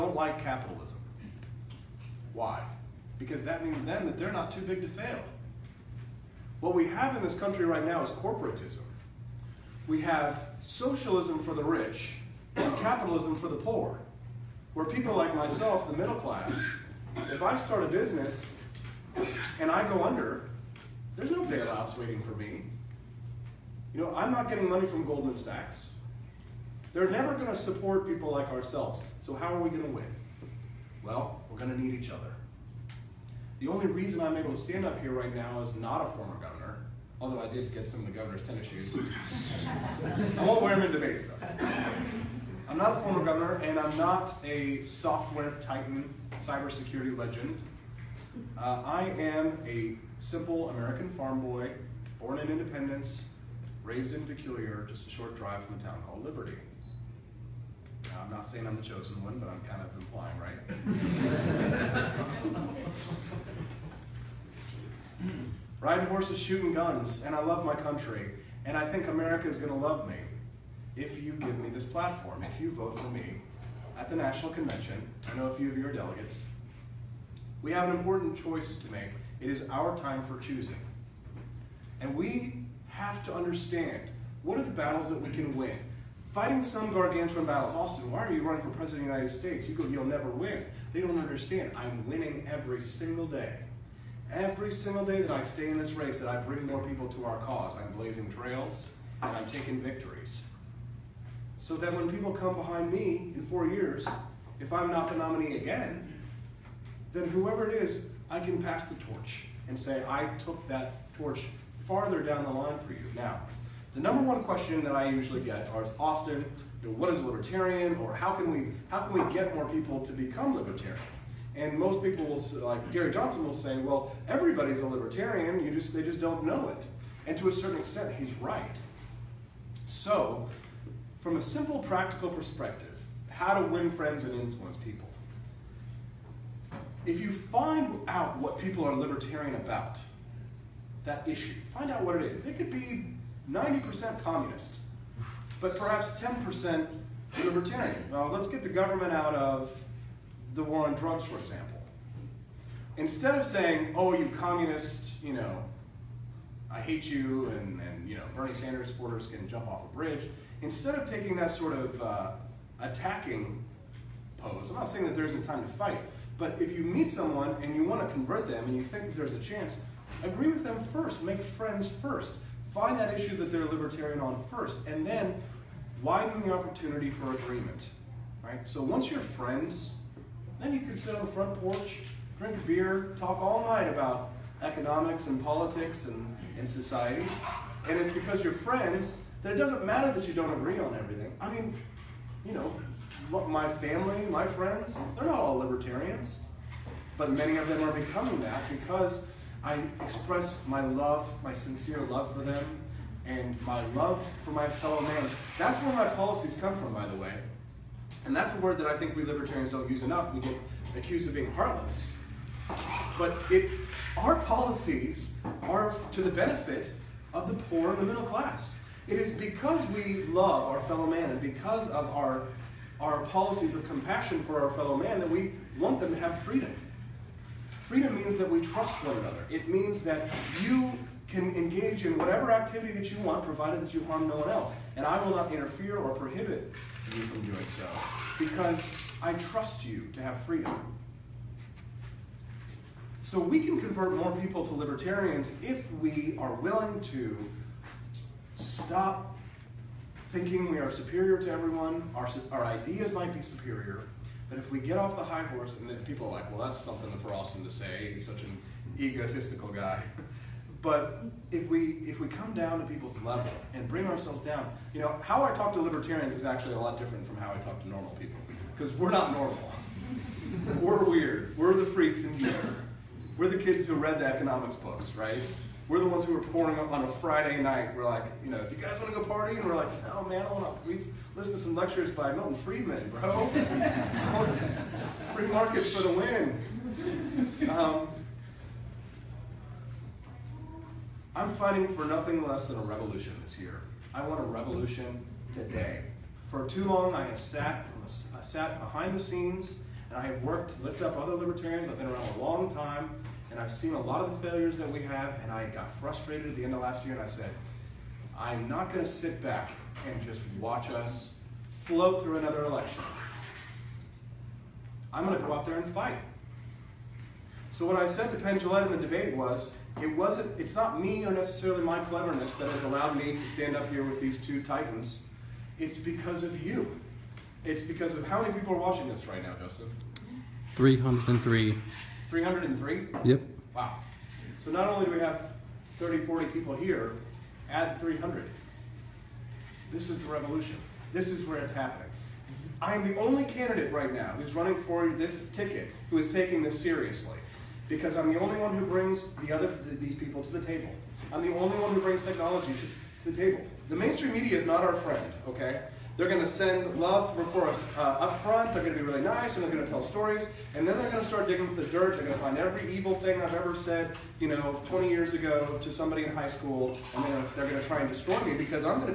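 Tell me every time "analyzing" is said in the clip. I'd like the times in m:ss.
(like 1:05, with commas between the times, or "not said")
not said.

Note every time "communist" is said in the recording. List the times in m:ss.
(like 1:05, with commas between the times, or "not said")
2:24, 2:34.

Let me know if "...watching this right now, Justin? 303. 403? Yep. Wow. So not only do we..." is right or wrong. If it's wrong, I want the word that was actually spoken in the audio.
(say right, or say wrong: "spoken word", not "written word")
wrong: "303", not "403".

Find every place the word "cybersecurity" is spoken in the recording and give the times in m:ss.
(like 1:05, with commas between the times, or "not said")
0:46.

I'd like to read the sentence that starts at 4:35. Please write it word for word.
We're the ones who are pouring on a Friday night.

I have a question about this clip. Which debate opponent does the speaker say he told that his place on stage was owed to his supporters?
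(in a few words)
Penn Jillette.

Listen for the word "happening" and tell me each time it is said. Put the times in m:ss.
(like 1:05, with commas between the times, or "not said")
5:41.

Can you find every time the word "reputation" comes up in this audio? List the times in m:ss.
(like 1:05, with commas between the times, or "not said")
not said.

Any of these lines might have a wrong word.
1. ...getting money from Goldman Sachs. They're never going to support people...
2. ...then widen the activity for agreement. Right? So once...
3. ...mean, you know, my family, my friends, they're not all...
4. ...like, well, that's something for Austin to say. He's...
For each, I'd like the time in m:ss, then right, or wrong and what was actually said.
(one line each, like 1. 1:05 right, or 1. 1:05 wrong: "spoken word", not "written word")
1. 0:24 right
2. 2:55 wrong: "opportunity", not "activity"
3. 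3:11 right
4. 4:16 right.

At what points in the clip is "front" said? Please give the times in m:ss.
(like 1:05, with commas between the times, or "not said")
3:01, 5:58.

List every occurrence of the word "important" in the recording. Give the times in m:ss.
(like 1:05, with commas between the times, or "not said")
1:17.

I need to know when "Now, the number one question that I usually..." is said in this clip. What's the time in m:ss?
1:53.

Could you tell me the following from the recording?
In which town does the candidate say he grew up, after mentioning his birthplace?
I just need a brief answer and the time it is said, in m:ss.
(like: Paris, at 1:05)
Peculiar, at 0:54.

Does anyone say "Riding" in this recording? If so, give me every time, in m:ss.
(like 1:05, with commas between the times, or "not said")
1:05.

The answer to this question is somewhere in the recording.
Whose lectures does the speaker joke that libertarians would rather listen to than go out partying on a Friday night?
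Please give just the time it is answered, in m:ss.
4:42.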